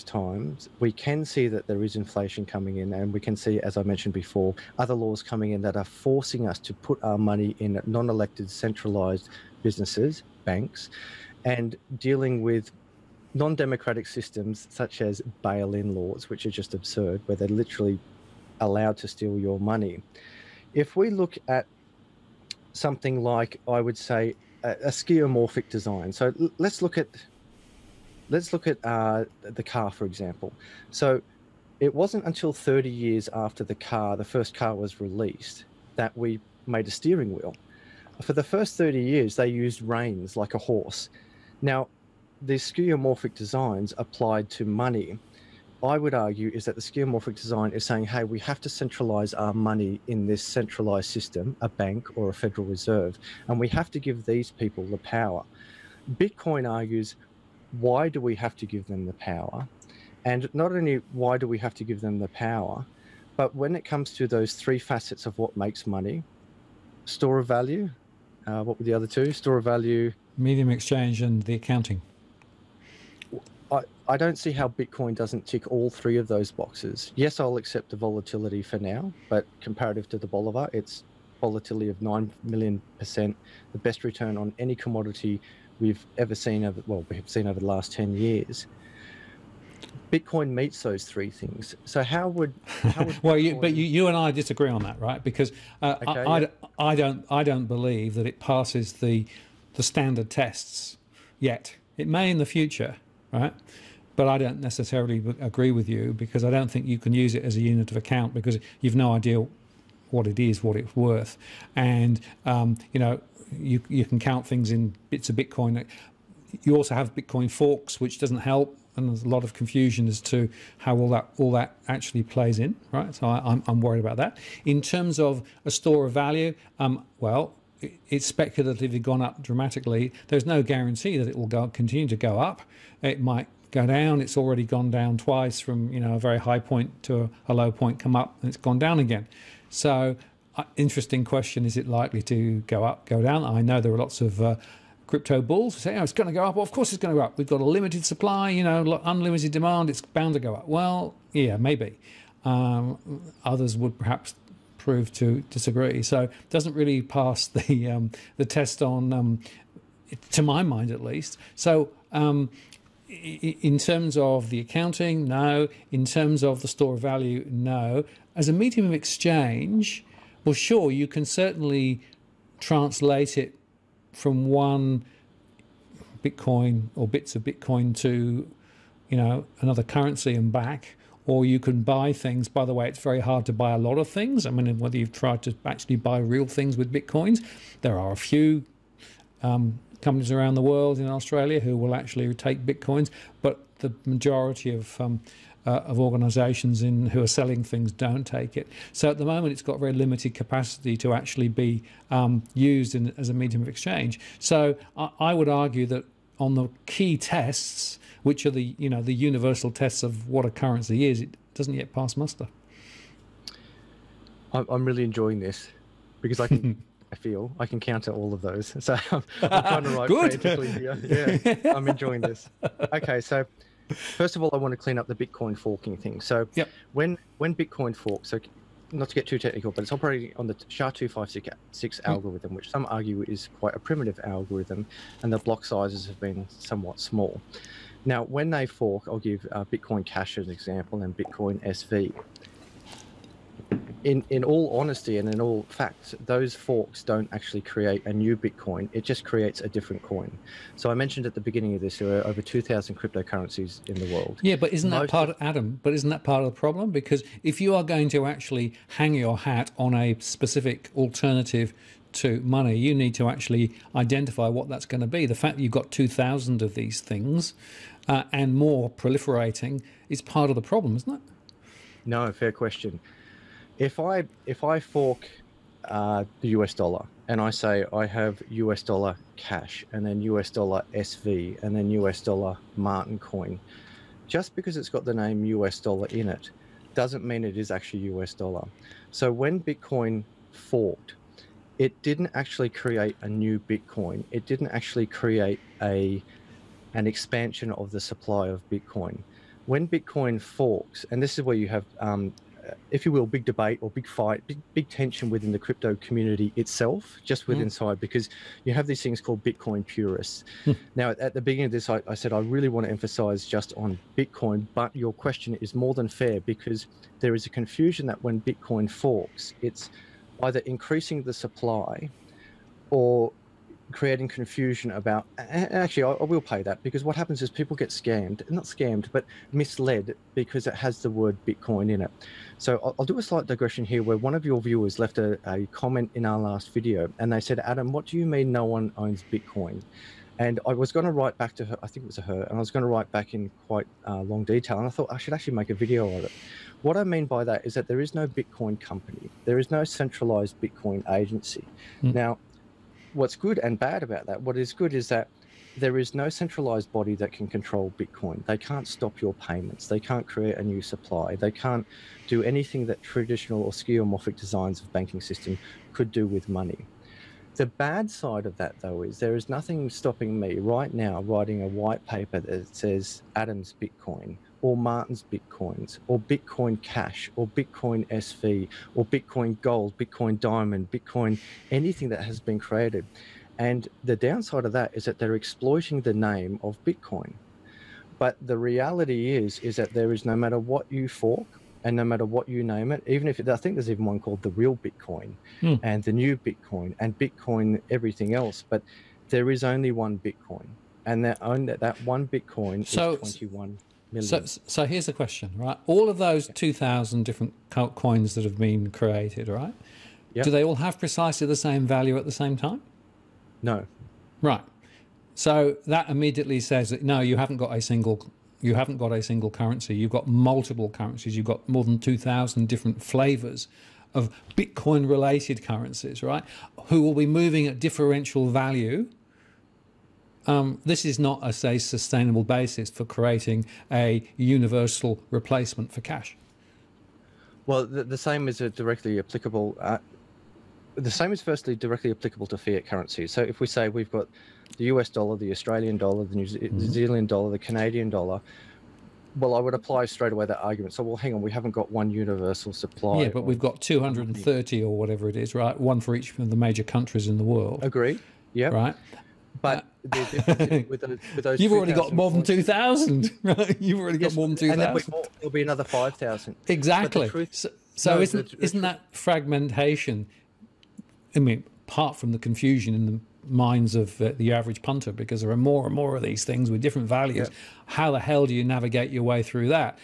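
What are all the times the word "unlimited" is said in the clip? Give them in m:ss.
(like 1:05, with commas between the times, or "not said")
2:29.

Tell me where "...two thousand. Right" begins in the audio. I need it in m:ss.
7:42.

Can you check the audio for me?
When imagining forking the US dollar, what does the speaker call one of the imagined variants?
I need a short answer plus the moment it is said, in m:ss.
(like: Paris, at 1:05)
Martin coin, at 4:41.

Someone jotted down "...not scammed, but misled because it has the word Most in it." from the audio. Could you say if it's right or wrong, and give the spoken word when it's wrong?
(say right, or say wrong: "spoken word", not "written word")
wrong: "Bitcoin", not "Most".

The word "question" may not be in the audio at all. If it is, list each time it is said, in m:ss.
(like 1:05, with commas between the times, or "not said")
2:21, 4:32, 5:15, 6:45.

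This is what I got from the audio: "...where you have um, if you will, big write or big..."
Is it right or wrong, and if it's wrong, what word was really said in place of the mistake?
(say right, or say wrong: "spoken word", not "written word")
wrong: "debate", not "write".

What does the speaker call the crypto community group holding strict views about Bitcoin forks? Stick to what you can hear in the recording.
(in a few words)
Bitcoin purists.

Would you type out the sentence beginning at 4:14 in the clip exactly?
Yeah, but isn't Most that part, of, Adam?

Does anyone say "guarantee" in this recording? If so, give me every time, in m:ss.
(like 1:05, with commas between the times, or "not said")
2:10.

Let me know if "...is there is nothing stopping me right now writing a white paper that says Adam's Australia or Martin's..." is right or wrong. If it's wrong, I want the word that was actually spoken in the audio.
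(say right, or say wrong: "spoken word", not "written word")
wrong: "Bitcoin", not "Australia".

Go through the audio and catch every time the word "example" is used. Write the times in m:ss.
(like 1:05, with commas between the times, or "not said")
0:30, 4:00.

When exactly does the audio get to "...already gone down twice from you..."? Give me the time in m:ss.
2:14.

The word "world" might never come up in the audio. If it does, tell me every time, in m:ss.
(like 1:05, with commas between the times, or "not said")
3:10, 4:14, 7:37.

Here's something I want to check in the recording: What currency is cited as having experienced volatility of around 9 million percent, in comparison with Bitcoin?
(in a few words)
Bolivar.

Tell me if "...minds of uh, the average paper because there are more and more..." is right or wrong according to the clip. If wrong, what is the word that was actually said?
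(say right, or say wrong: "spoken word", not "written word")
wrong: "punter", not "paper".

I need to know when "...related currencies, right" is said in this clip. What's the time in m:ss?
7:05.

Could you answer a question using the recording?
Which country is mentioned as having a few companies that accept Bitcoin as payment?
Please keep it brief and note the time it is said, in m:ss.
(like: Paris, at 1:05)
Australia, at 3:11.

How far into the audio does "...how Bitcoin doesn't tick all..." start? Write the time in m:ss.
1:14.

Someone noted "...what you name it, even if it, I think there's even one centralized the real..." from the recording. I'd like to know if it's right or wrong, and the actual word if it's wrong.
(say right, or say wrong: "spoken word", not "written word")
wrong: "called", not "centralized".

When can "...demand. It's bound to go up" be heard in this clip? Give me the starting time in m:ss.
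2:29.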